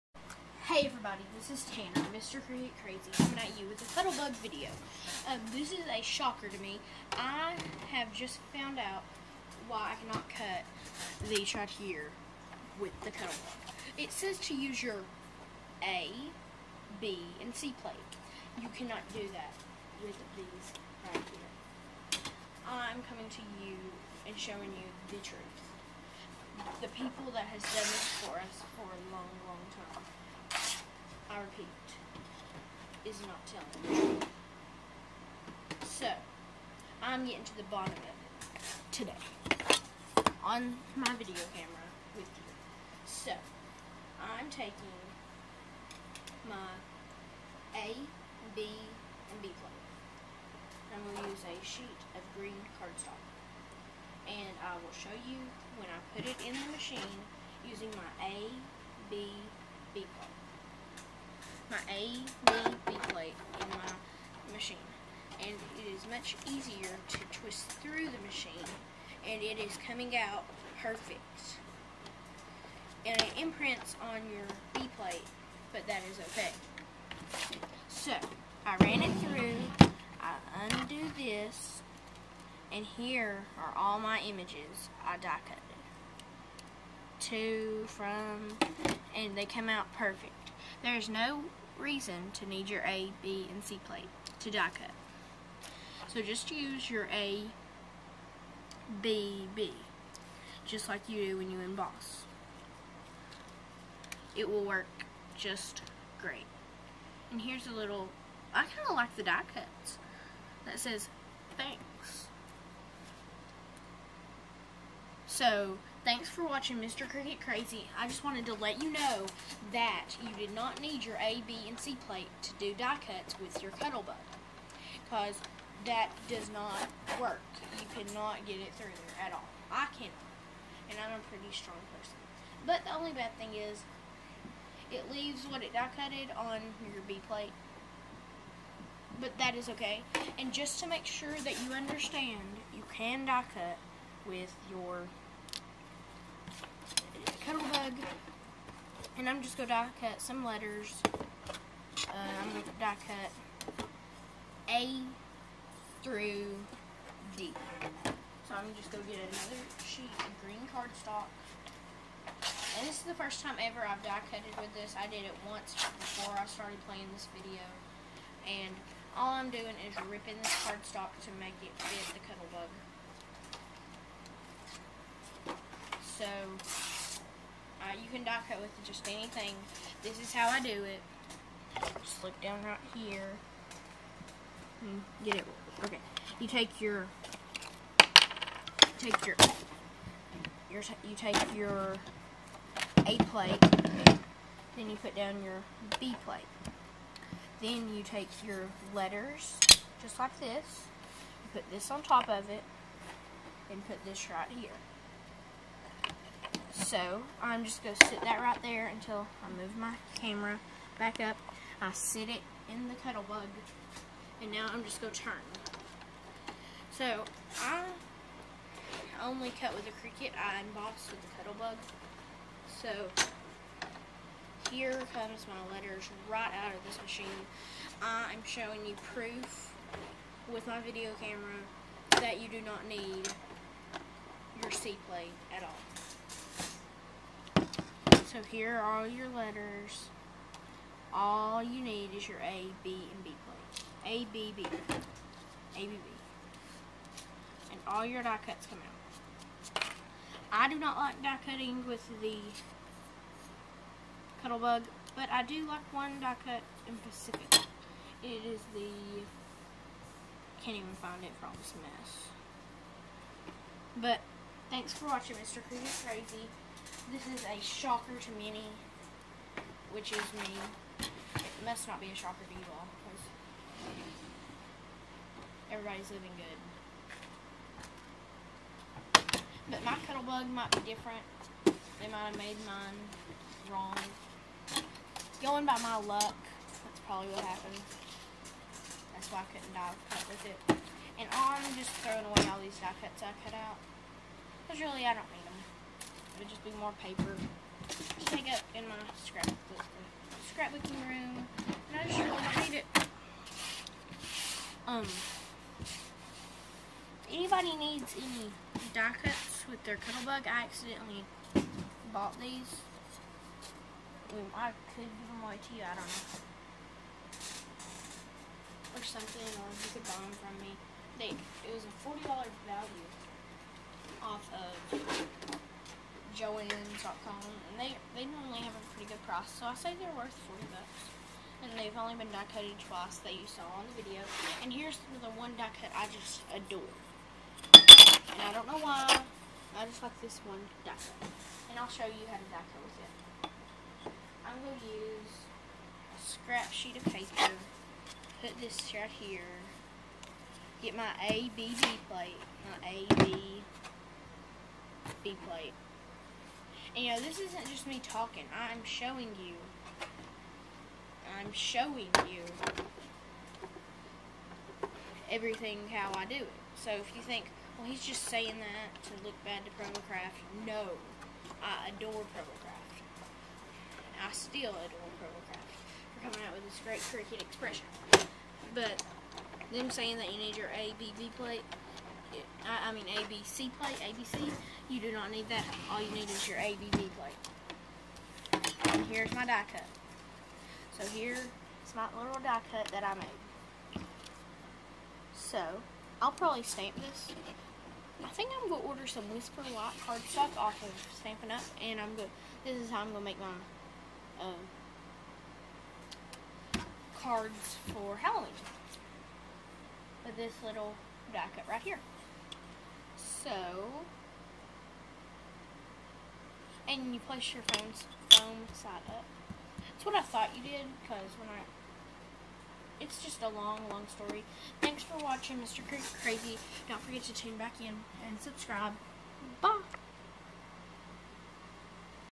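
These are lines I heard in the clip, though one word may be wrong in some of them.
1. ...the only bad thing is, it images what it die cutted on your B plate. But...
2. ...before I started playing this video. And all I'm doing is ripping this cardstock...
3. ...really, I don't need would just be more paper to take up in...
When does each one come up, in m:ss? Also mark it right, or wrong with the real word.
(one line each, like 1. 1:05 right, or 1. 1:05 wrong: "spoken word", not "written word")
1. 2:12 wrong: "leaves", not "images"
2. 2:45 right
3. 4:54 right.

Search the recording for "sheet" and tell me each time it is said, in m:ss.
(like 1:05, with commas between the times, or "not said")
0:51, 2:39, 5:46.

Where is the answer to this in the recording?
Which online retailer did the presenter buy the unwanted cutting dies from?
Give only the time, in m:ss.
5:26.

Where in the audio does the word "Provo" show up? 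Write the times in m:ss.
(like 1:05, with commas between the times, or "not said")
6:09, 6:15.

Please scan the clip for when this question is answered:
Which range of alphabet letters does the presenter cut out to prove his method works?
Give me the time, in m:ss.
2:34.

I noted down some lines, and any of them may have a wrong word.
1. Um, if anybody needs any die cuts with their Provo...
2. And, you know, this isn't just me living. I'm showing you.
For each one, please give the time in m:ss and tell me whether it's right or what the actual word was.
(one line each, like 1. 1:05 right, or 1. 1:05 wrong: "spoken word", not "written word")
1. 5:04 wrong: "Cuttlebug", not "Provo"
2. 5:56 wrong: "talking", not "living".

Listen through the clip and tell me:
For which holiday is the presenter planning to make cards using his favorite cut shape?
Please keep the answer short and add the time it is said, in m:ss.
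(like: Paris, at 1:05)
Halloween, at 6:48.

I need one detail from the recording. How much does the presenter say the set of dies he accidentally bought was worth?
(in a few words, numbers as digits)
$40.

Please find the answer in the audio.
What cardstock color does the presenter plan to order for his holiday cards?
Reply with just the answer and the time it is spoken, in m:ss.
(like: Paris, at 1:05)
Whisper White, at 6:39.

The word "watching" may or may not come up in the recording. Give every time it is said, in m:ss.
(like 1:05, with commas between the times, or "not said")
1:56, 4:25, 7:05.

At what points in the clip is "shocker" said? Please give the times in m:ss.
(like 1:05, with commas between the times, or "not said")
0:06, 4:27, 4:32.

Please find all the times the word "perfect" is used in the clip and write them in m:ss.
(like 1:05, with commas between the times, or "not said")
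1:10, 1:29.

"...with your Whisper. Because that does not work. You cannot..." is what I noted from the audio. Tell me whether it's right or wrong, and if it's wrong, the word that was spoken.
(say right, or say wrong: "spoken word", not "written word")
wrong: "Cuttlebug", not "Whisper".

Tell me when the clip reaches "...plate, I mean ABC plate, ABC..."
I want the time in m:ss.
6:21.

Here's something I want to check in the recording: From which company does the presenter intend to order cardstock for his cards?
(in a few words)
Stampin' Up.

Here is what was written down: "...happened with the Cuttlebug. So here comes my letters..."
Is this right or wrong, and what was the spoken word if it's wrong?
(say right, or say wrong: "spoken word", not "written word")
wrong: "embossed", not "happened".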